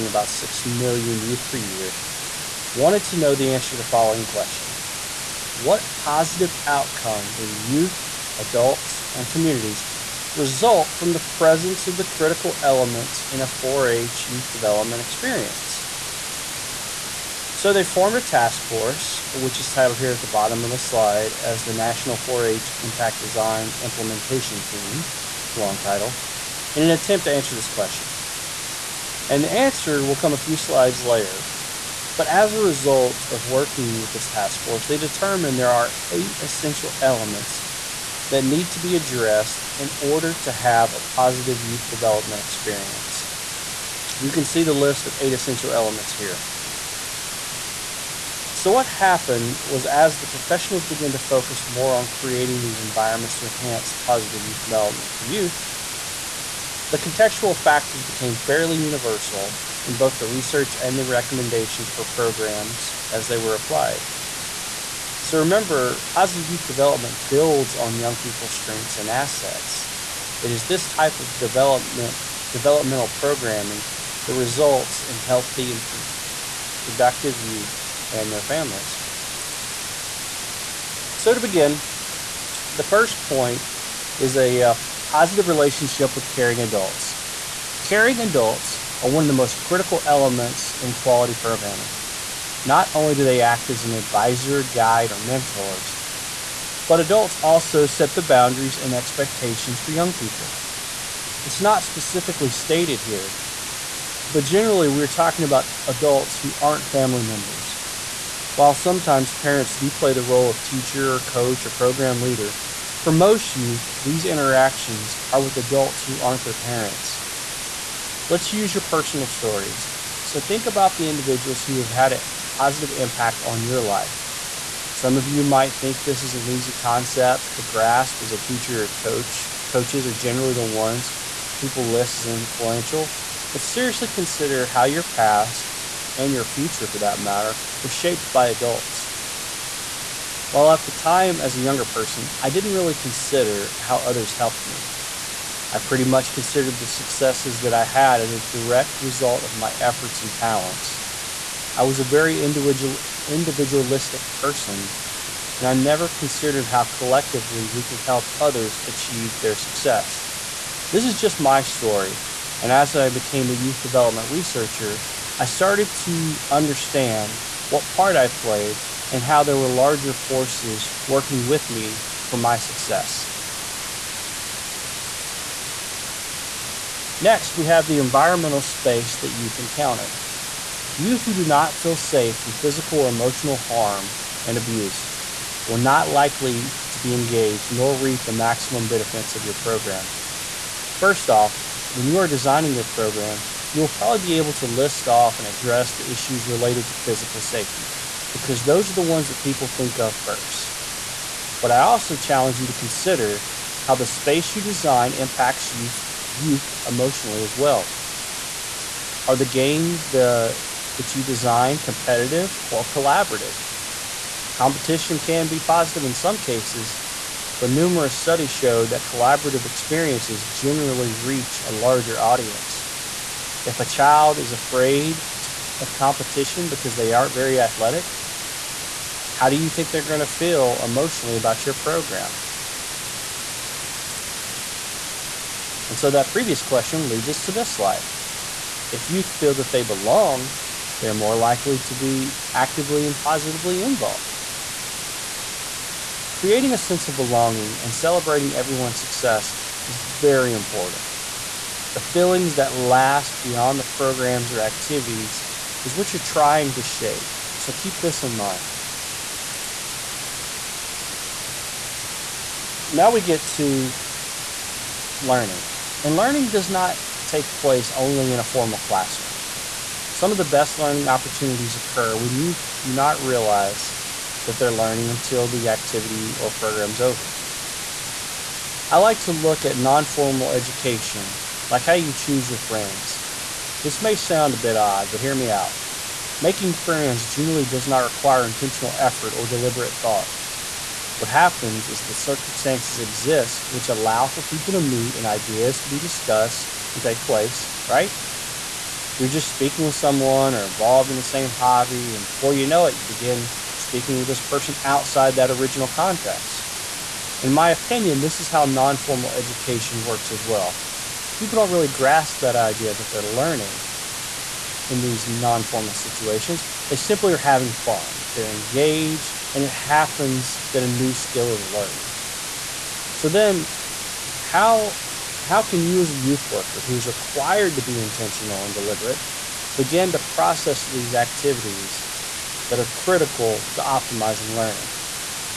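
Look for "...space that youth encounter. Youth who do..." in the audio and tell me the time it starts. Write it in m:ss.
2:58.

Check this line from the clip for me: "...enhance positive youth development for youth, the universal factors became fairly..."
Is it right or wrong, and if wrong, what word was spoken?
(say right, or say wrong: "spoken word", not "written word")
wrong: "contextual", not "universal".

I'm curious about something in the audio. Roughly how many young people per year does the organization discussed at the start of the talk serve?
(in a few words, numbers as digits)
about 6 million.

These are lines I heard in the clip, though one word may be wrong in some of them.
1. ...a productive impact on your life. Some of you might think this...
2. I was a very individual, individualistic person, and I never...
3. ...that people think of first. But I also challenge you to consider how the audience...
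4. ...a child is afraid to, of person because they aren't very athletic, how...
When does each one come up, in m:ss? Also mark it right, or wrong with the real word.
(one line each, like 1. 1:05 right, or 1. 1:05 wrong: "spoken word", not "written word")
1. 2:02 wrong: "positive", not "productive"
2. 2:31 right
3. 3:19 wrong: "space", not "audience"
4. 3:43 wrong: "competition", not "person".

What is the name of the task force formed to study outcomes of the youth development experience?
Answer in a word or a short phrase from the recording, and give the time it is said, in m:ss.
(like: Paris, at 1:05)
National 4-H Impact Design Implementation Team, at 0:21.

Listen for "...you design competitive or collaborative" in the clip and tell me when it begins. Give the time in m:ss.
3:31.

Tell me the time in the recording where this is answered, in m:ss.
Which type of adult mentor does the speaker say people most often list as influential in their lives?
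2:09.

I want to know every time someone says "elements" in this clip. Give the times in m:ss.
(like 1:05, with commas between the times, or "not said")
0:12, 0:36, 0:45, 1:30.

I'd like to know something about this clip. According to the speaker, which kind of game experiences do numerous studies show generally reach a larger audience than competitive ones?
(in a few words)
Collaborative experiences.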